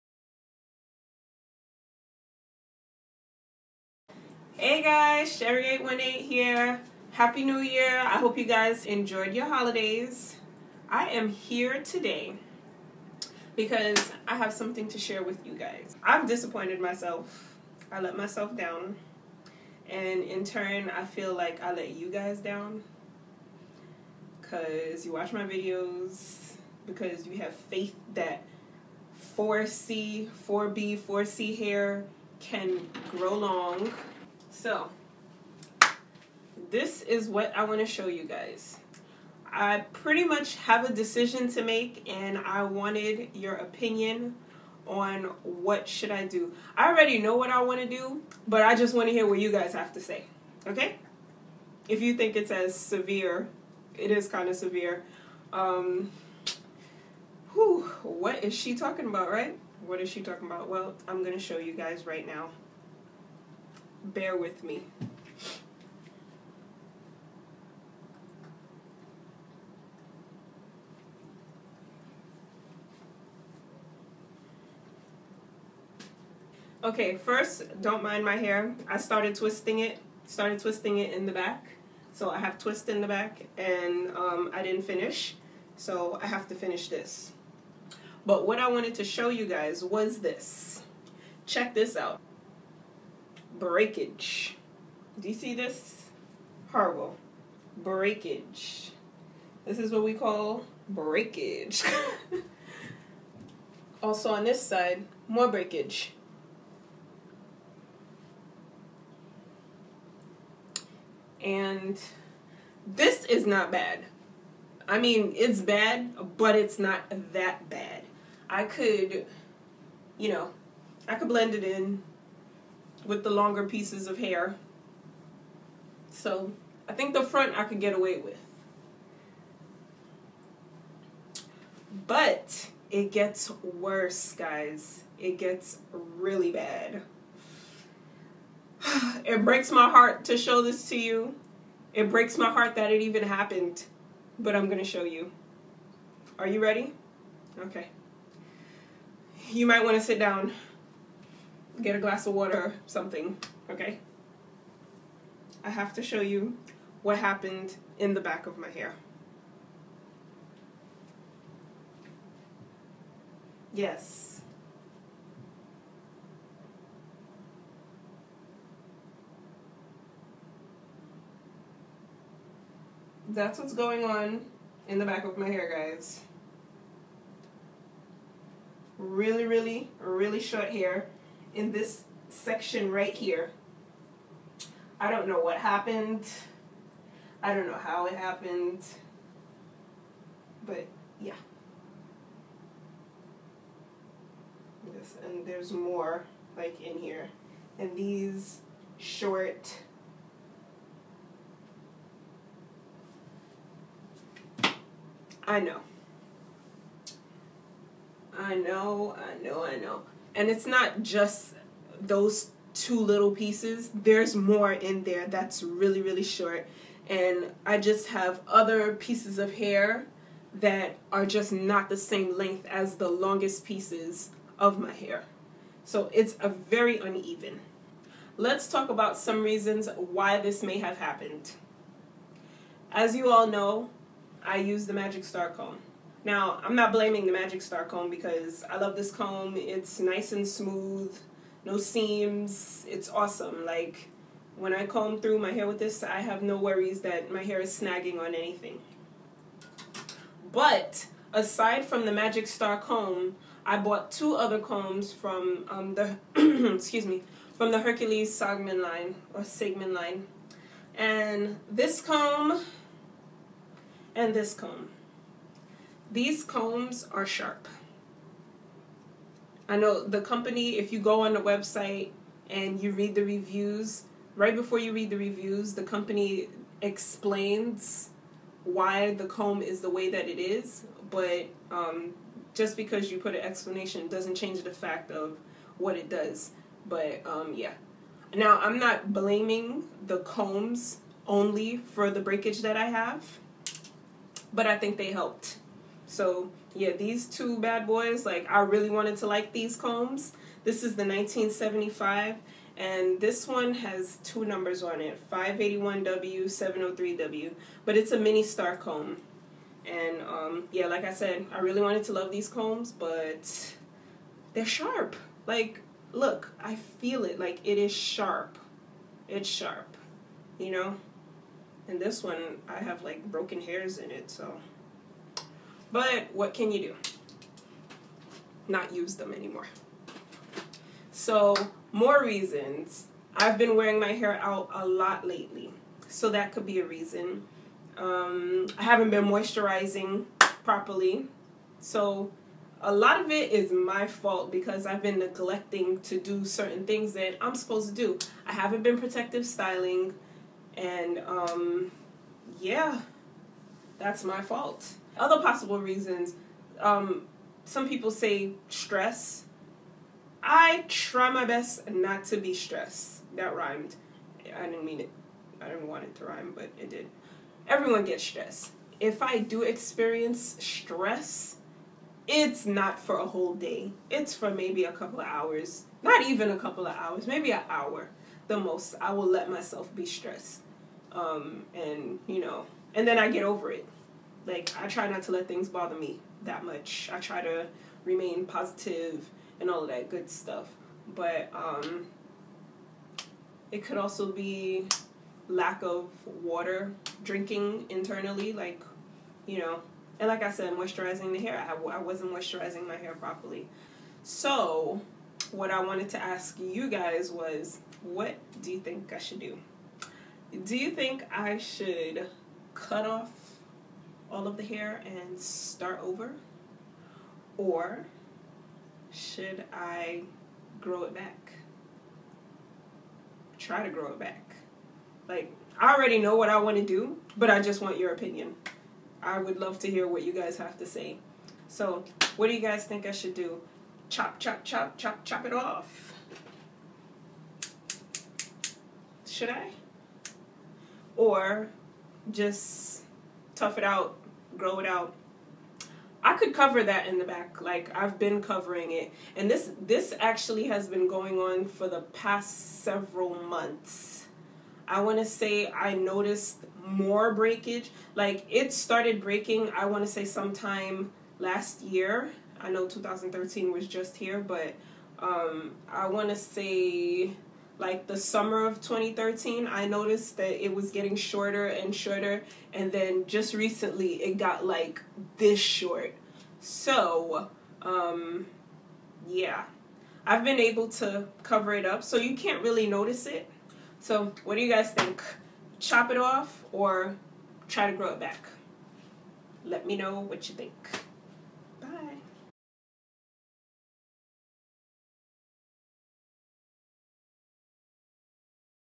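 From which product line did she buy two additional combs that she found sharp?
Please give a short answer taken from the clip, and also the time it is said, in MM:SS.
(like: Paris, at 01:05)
Hercules Sagman, at 04:17.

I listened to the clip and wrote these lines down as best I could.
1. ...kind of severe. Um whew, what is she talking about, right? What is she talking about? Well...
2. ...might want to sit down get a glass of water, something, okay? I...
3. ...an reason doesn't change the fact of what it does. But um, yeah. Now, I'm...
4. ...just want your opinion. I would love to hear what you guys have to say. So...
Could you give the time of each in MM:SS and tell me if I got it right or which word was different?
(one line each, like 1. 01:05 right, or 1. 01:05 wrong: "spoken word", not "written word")
1. 00:54 right
2. 02:29 right
3. 04:43 wrong: "explanation", not "reason"
4. 07:07 right.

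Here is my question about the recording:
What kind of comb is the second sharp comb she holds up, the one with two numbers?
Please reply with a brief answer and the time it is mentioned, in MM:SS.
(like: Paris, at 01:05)
mini star comb, at 05:08.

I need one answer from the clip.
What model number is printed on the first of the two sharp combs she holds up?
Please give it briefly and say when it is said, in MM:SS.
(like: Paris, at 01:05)
1975, at 05:01.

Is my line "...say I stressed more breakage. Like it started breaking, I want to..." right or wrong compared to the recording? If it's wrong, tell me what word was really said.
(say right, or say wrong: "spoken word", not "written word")
wrong: "noticed", not "stressed".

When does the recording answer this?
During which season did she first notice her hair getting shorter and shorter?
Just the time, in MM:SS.
07:48.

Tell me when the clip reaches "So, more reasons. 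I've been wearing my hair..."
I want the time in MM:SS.
05:31.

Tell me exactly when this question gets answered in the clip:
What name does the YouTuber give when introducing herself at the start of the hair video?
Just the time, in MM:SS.
00:05.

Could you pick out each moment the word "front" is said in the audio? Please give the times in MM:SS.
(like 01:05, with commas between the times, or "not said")
02:07.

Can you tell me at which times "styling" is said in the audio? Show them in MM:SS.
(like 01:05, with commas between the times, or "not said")
05:49.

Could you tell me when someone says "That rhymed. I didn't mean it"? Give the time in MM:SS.
06:03.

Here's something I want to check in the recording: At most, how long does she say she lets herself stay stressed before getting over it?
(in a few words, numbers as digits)
an hour.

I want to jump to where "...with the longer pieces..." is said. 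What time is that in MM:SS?
02:03.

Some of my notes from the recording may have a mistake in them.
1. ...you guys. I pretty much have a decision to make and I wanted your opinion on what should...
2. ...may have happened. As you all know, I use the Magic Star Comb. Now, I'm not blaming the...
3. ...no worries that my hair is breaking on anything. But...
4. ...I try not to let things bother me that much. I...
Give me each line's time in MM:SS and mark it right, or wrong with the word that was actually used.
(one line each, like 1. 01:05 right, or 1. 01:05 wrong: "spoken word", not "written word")
1. 00:38 right
2. 03:50 right
3. 04:06 wrong: "snagging", not "breaking"
4. 06:24 right.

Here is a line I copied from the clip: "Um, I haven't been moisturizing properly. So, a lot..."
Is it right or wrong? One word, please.
right.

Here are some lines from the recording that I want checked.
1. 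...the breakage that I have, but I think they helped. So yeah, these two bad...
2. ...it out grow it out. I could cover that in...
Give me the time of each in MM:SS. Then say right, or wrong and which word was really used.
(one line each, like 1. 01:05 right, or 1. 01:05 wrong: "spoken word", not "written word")
1. 04:52 right
2. 07:23 right.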